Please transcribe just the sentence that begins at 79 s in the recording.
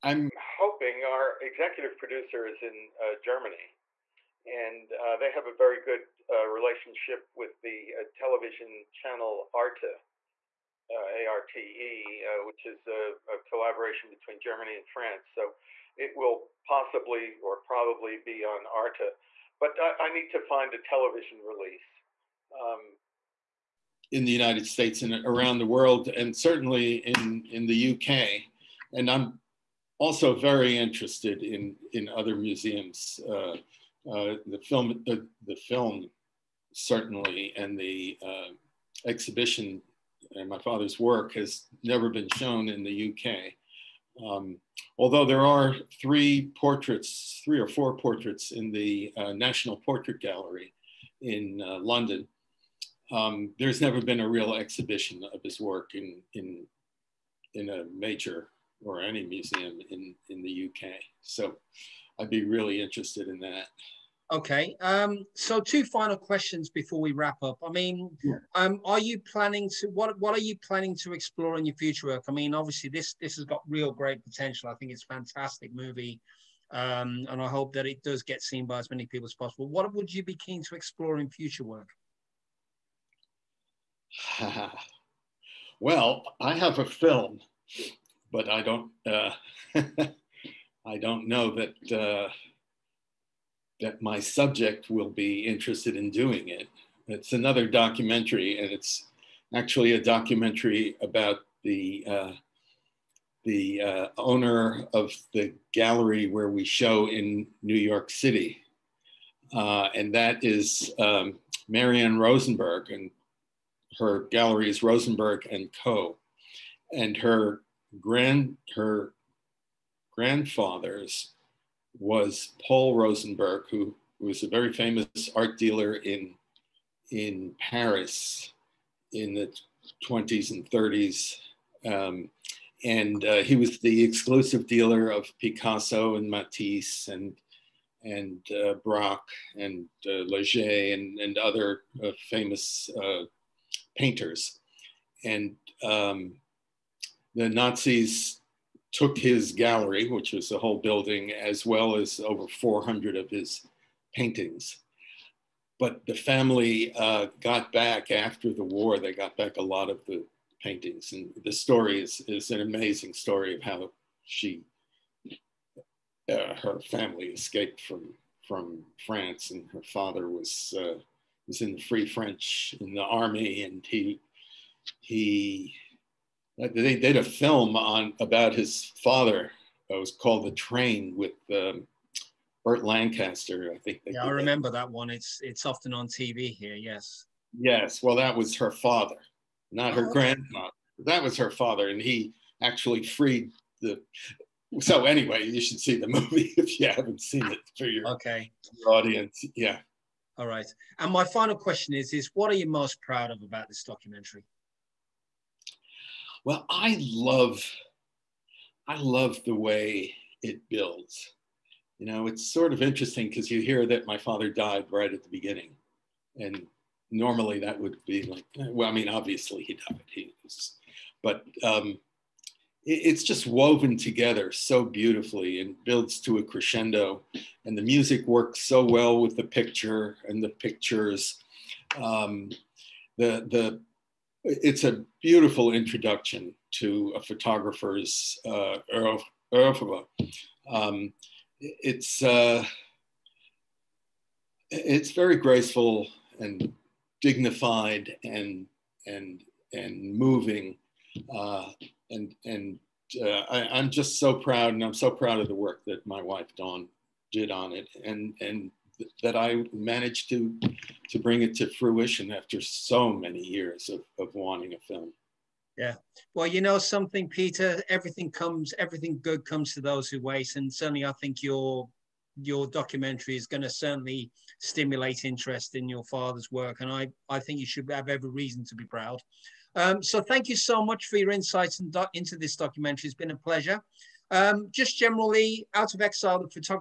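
What would you be keen to explore in future work?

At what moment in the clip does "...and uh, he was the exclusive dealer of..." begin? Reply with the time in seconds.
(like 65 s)
132 s.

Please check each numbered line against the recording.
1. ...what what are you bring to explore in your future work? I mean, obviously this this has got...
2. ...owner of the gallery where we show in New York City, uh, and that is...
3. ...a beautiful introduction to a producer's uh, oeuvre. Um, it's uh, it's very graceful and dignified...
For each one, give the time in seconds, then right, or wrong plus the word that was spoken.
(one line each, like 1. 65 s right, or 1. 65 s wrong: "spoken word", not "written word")
1. 69 s wrong: "planning", not "bring"
2. 104 s right
3. 234 s wrong: "photographer", not "producer".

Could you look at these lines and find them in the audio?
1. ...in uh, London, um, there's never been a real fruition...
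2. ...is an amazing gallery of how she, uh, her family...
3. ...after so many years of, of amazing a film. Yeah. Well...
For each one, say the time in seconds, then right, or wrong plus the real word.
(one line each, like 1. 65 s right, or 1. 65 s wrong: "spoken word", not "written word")
1. 51 s wrong: "exhibition", not "fruition"
2. 162 s wrong: "story", not "gallery"
3. 262 s wrong: "wanting", not "amazing".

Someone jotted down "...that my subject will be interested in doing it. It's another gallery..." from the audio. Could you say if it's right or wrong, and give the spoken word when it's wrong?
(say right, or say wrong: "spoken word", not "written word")
wrong: "documentary", not "gallery".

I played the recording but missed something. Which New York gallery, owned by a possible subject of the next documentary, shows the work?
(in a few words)
Rosenberg and Co.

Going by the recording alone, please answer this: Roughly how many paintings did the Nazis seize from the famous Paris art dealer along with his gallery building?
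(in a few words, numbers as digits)
over 400.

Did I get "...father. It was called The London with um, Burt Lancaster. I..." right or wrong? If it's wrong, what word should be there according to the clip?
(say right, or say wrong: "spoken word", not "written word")
wrong: "Train", not "London".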